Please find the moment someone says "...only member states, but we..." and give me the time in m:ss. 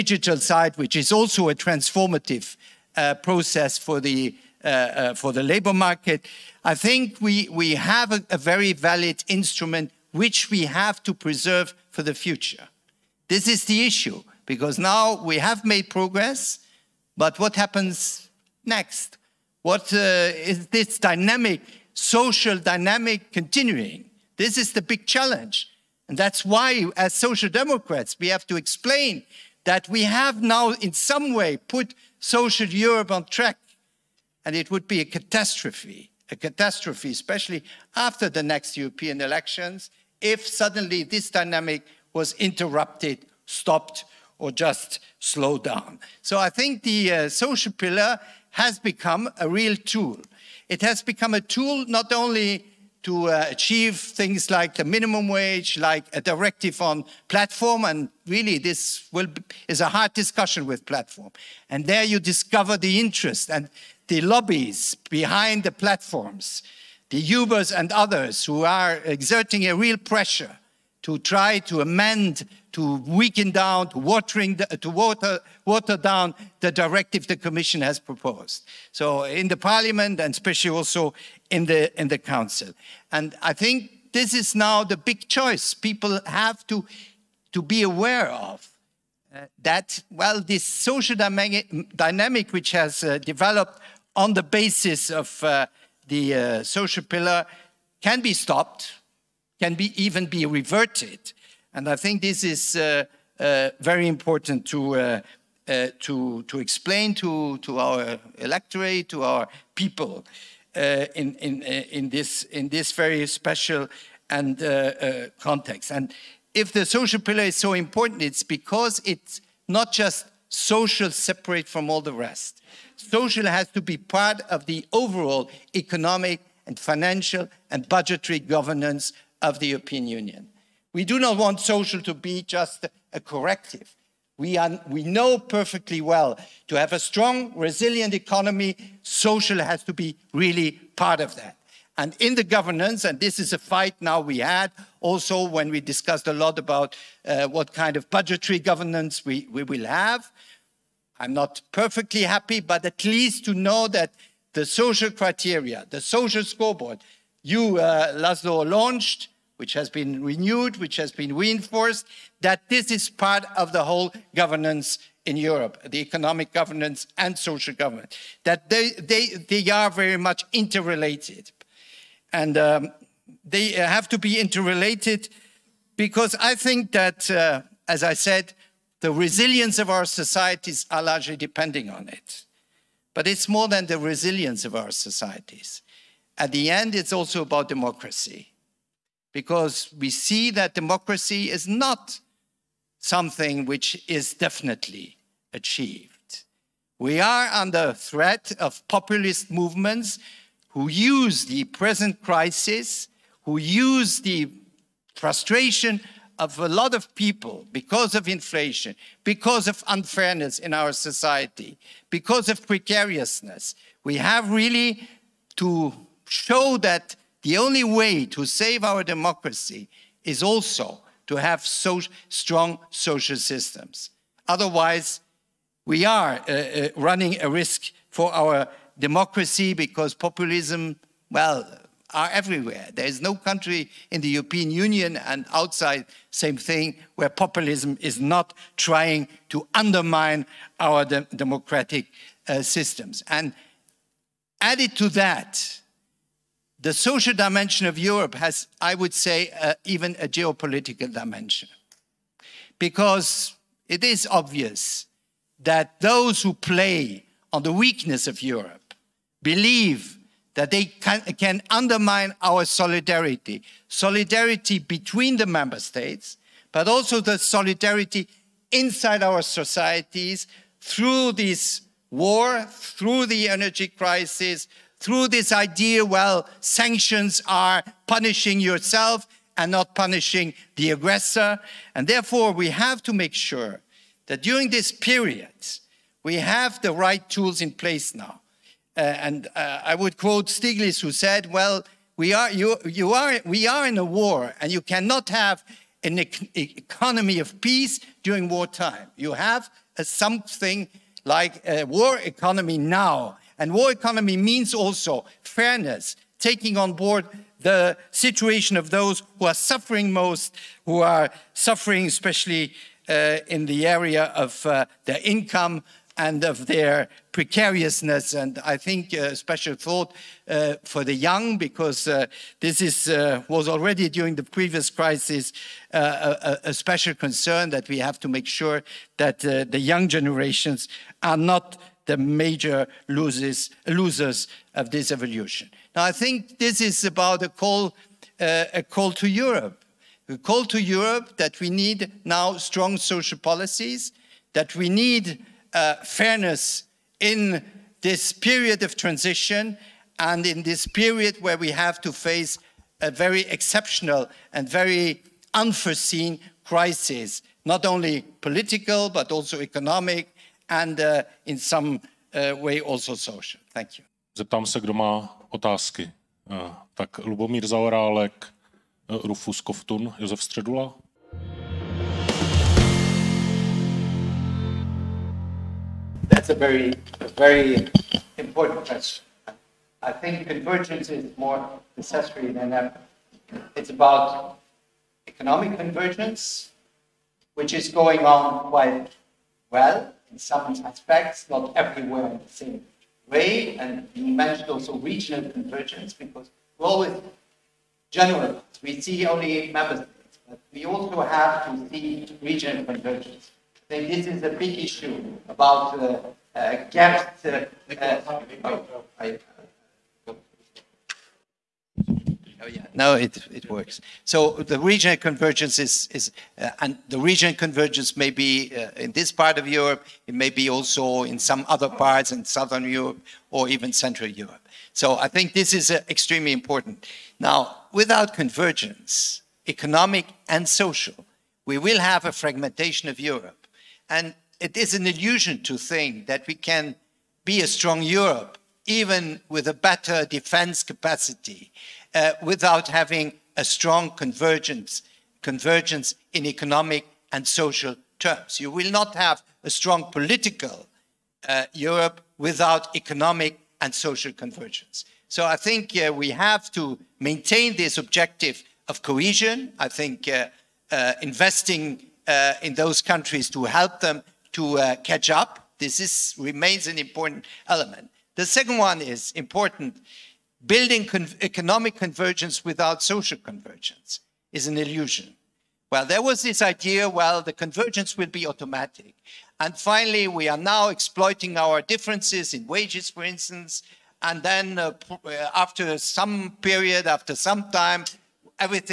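6:39.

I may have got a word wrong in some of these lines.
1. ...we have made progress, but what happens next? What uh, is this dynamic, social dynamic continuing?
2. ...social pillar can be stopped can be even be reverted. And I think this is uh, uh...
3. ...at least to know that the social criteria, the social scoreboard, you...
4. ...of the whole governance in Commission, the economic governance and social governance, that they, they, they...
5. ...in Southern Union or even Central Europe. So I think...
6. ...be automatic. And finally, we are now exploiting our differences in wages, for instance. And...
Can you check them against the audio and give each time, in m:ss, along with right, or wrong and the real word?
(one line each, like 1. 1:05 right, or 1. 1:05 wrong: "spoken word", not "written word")
1. 0:15 right
2. 1:36 right
3. 2:32 right
4. 2:43 wrong: "Europe", not "Commission"
5. 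7:02 wrong: "Europe", not "Union"
6. 7:58 right.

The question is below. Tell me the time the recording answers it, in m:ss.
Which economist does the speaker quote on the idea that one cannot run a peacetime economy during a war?
4:50.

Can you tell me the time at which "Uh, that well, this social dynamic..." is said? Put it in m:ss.
1:29.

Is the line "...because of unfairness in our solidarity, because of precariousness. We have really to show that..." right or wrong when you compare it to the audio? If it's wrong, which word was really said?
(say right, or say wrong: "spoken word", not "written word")
wrong: "society", not "solidarity".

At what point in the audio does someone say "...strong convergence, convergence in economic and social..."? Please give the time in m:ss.
7:23.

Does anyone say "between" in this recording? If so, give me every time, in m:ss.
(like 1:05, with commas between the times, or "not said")
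4:24.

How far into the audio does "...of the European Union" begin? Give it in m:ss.
2:09.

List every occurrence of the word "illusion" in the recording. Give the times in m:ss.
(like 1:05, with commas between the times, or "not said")
7:15, 7:54.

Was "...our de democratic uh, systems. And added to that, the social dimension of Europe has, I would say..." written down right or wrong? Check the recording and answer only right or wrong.
right.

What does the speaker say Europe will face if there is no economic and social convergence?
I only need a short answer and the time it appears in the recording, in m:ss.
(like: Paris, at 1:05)
Fragmentation, at 7:12.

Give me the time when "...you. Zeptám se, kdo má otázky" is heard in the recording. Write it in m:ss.
6:03.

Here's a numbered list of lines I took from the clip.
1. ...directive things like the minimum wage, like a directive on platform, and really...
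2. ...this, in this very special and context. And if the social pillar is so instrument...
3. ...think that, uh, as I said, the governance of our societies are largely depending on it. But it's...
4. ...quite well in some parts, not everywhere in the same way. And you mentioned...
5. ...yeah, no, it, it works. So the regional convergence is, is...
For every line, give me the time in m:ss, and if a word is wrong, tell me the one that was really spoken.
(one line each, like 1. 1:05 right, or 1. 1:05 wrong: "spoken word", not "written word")
1. 0:53 wrong: "achieve", not "directive"
2. 1:52 wrong: "important", not "instrument"
3. 2:56 wrong: "resilience", not "governance"
4. 6:28 wrong: "aspects", not "parts"
5. 6:52 right.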